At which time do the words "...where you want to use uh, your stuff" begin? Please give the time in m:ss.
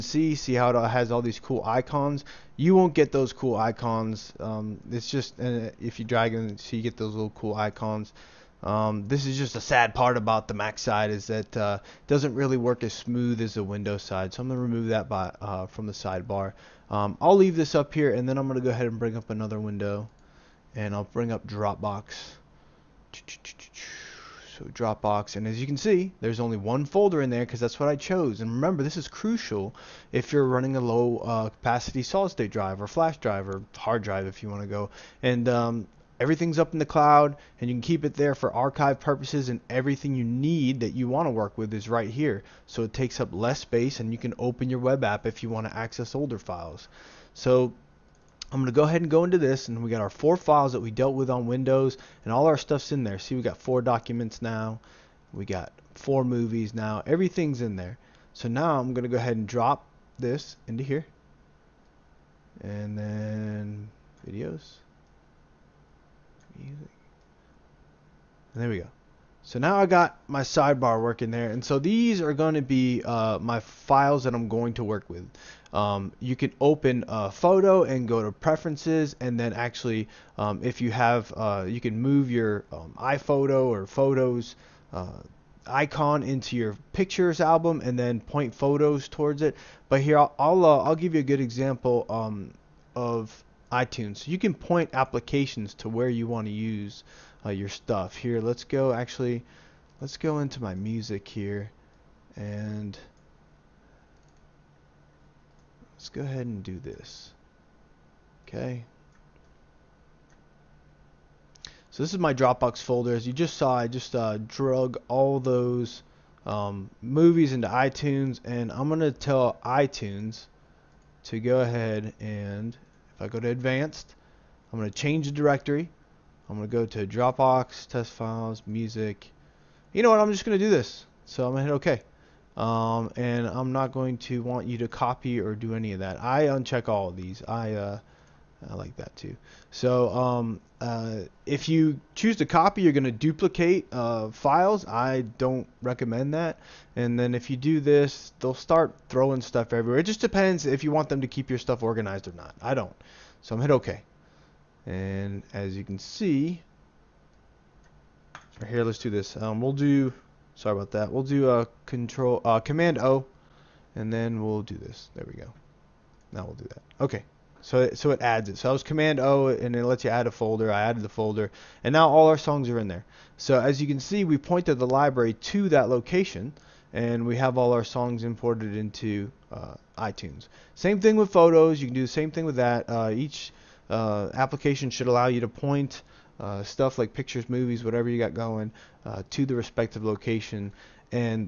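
1:35.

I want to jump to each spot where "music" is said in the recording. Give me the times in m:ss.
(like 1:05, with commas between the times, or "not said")
1:06, 1:40, 2:08.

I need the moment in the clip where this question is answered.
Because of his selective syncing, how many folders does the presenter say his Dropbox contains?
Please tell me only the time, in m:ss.
0:26.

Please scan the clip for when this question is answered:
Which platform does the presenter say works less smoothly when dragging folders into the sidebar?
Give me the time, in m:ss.
0:10.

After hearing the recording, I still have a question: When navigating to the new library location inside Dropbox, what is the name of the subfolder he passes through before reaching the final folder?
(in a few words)
test files.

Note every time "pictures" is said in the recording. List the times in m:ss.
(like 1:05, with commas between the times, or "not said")
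1:26, 3:07.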